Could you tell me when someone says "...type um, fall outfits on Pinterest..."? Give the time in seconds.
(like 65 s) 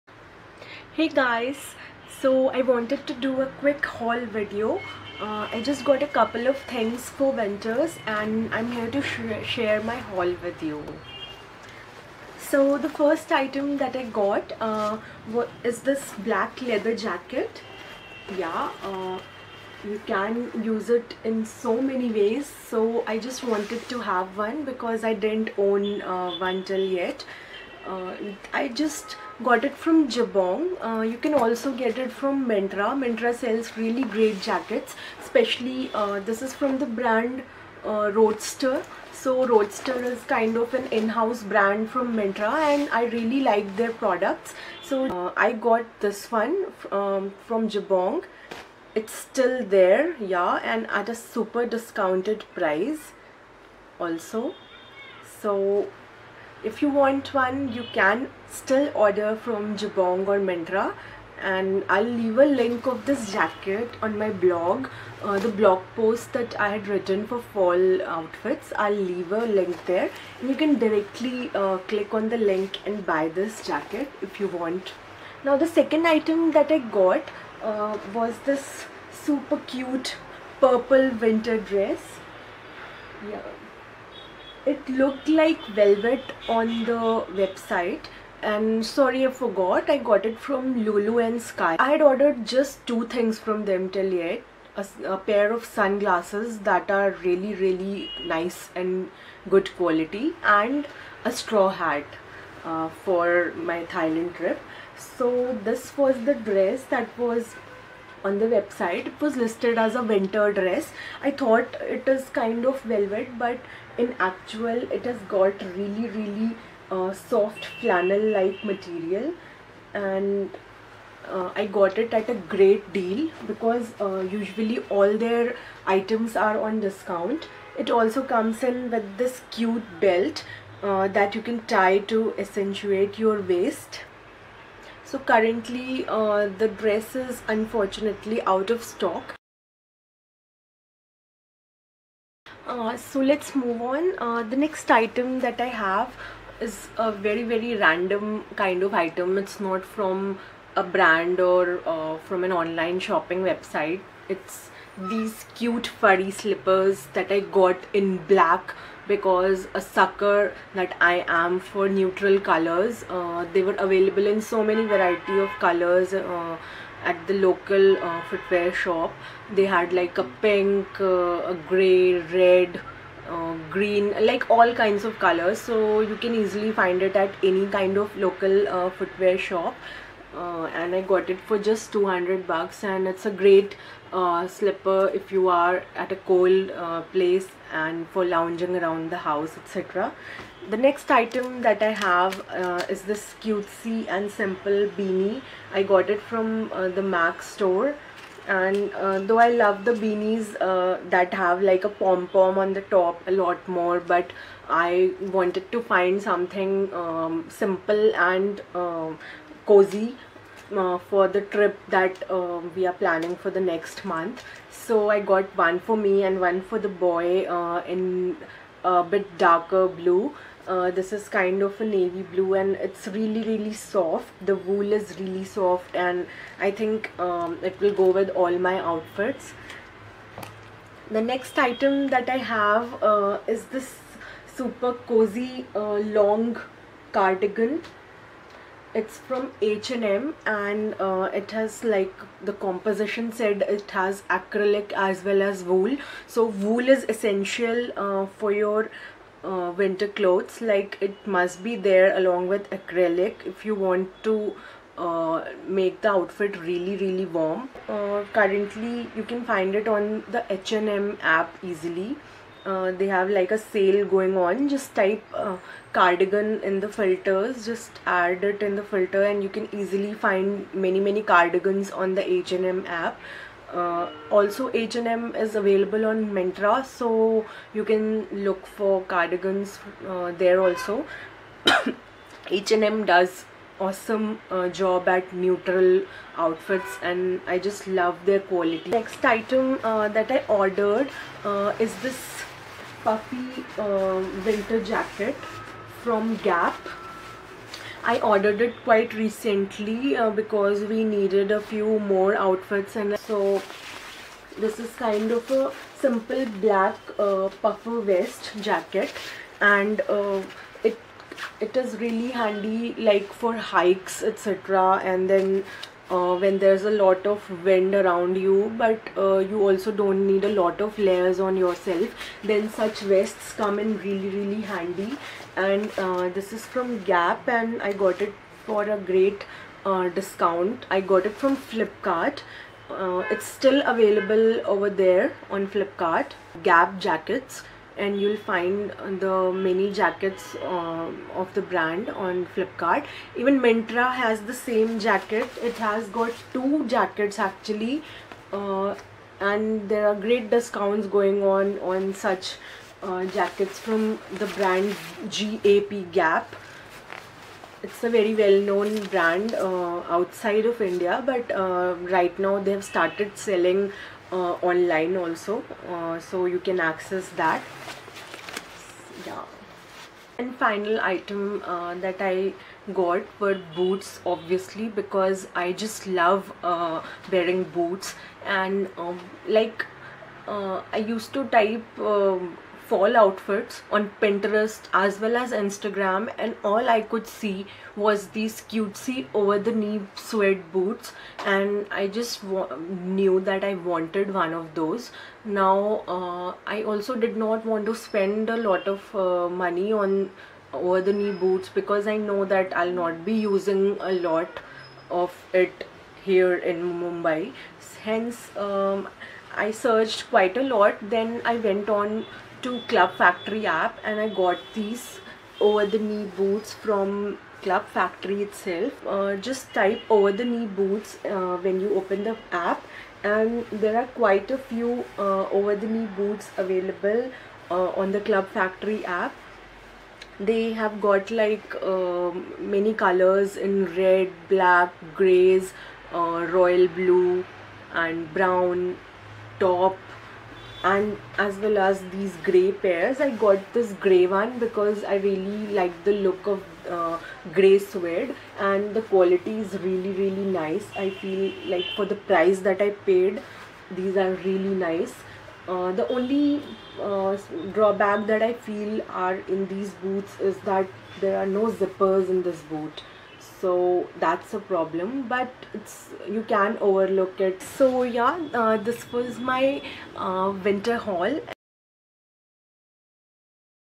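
381 s.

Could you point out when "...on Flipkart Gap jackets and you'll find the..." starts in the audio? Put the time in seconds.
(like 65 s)
335 s.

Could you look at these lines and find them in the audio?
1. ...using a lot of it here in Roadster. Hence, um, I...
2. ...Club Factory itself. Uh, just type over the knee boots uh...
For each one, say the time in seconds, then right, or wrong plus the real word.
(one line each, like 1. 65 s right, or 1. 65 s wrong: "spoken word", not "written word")
1. 403 s wrong: "Mumbai", not "Roadster"
2. 417 s right.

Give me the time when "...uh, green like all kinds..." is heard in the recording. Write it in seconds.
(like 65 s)
173 s.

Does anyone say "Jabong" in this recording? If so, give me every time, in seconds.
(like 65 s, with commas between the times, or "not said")
30 s, 47 s, 59 s.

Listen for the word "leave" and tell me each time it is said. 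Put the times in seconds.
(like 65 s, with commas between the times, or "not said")
62 s, 69 s.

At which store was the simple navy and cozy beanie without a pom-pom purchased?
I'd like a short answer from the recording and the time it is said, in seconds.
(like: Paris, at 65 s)
MAC store, at 197 s.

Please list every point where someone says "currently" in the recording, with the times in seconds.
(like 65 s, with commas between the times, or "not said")
135 s, 258 s.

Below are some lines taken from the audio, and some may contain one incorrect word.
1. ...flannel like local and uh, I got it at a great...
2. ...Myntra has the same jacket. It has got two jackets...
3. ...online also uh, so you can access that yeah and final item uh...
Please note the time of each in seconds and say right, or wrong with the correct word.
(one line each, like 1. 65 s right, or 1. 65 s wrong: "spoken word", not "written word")
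1. 117 s wrong: "material", not "local"
2. 343 s right
3. 364 s right.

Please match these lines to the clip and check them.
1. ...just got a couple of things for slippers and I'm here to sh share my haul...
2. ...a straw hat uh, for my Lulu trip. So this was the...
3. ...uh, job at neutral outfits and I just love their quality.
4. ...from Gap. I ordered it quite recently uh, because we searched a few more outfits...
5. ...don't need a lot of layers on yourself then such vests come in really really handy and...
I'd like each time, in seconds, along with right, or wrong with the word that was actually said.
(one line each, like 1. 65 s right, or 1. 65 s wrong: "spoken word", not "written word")
1. 5 s wrong: "winters", not "slippers"
2. 101 s wrong: "Thailand", not "Lulu"
3. 284 s right
4. 296 s wrong: "needed", not "searched"
5. 319 s right.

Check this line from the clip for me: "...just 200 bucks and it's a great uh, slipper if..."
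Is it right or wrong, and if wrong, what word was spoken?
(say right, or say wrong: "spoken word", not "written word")
right.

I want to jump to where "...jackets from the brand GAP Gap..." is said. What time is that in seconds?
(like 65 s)
353 s.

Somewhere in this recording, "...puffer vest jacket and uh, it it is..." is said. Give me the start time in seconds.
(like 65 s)
307 s.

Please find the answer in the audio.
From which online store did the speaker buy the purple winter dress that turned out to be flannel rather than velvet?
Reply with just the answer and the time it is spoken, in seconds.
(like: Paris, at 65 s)
Lulu and Sky, at 90 s.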